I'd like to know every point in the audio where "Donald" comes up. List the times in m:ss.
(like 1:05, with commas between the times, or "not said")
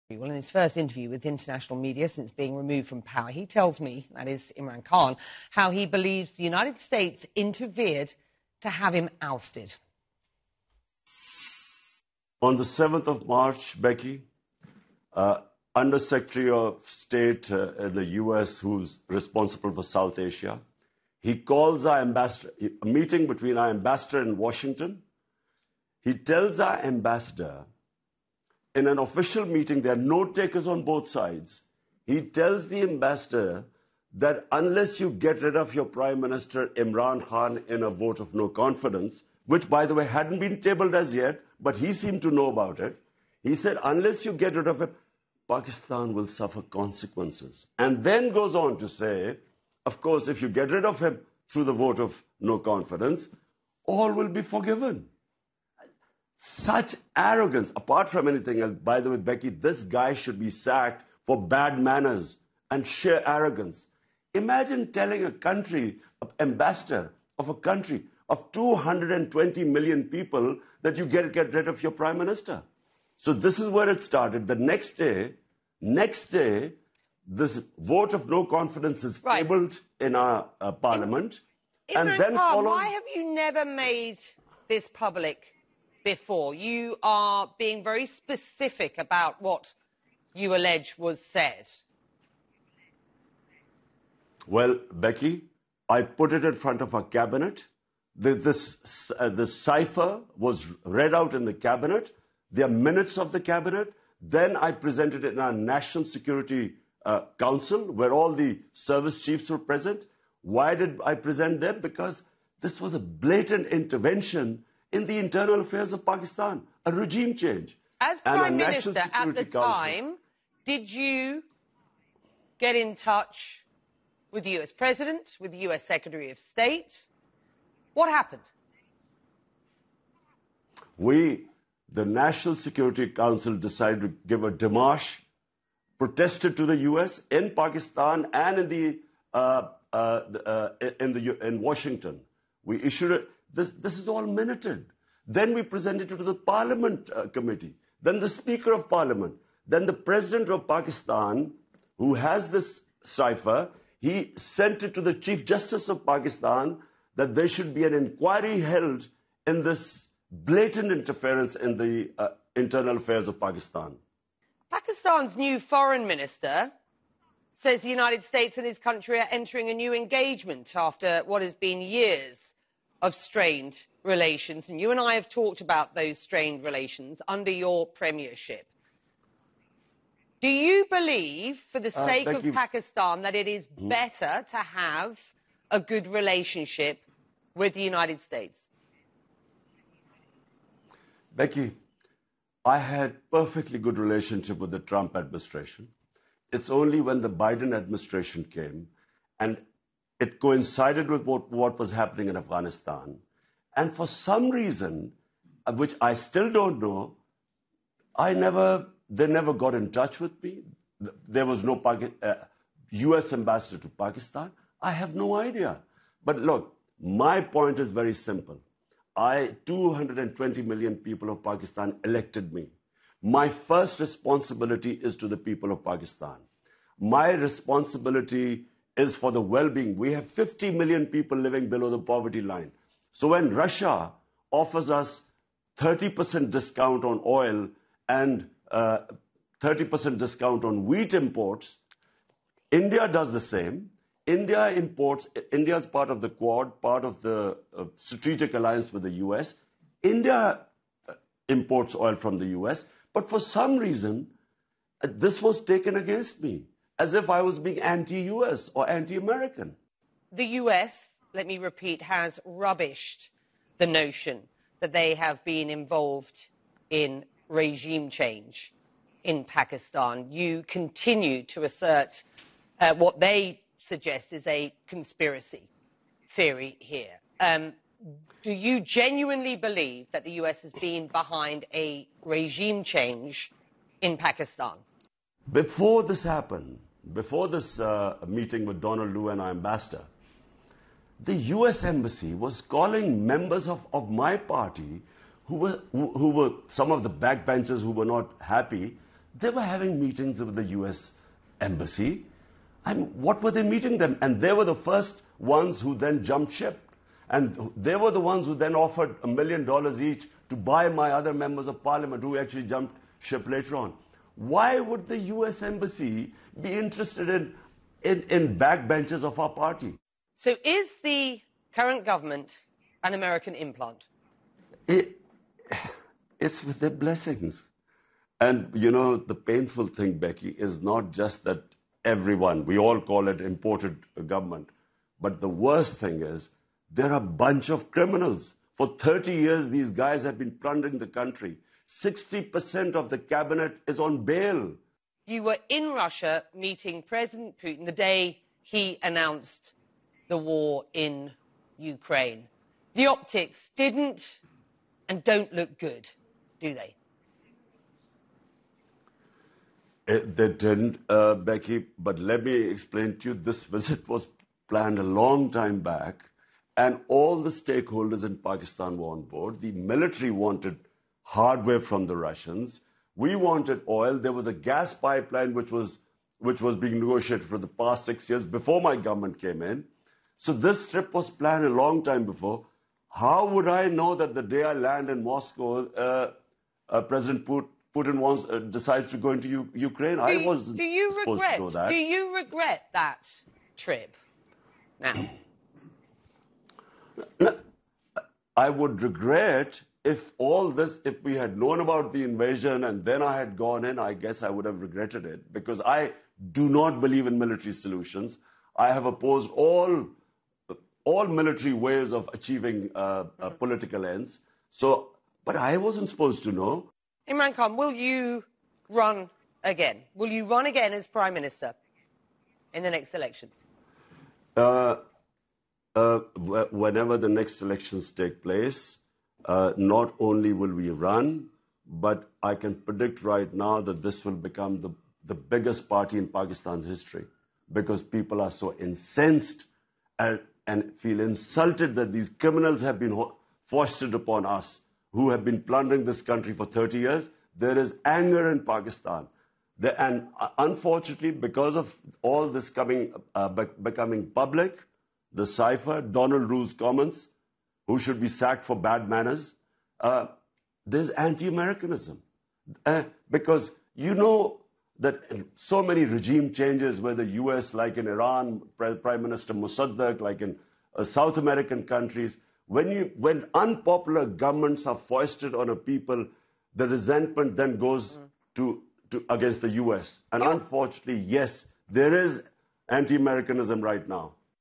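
4:48, 7:36.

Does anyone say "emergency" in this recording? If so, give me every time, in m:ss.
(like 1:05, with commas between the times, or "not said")
not said.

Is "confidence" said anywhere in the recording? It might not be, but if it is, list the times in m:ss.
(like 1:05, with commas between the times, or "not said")
0:38, 0:52, 1:18.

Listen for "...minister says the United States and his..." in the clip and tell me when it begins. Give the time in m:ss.
2:46.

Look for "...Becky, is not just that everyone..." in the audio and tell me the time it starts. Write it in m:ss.
5:30.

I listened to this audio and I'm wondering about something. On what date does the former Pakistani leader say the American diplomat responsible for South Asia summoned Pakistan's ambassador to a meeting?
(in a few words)
7th of March.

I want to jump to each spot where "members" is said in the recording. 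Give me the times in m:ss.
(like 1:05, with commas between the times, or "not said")
4:53, 5:11.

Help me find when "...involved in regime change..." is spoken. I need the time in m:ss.
4:25.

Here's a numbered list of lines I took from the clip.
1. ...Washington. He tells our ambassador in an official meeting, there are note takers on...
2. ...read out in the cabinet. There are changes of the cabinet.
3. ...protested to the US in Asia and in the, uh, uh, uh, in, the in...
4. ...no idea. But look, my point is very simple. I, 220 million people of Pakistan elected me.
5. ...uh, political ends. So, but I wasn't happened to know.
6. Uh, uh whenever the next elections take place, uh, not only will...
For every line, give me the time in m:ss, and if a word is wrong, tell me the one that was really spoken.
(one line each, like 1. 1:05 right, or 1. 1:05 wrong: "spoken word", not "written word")
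1. 0:24 right
2. 1:40 wrong: "minutes", not "changes"
3. 2:15 wrong: "Pakistan", not "Asia"
4. 3:35 right
5. 6:53 wrong: "supposed", not "happened"
6. 7:04 right.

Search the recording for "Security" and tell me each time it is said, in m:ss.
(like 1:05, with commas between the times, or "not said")
1:46, 2:12.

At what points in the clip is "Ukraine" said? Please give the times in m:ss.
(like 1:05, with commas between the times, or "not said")
5:51, 6:29.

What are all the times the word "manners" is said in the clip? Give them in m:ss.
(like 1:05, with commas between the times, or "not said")
1:01, 7:39.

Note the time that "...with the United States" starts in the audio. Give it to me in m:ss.
3:07.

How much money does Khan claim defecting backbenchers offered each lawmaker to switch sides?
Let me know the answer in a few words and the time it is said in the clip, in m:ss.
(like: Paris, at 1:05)
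a million dollars, at 5:09.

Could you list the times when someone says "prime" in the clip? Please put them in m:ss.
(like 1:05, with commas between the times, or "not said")
0:35, 1:11, 1:58, 7:01, 7:48.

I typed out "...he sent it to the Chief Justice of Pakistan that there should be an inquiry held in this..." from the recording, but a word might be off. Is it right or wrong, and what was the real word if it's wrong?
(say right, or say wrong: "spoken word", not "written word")
right.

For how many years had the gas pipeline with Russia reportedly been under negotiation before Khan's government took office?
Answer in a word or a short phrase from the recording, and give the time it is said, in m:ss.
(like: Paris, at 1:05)
six years, at 6:18.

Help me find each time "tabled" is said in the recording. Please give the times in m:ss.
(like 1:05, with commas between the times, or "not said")
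0:40, 1:19.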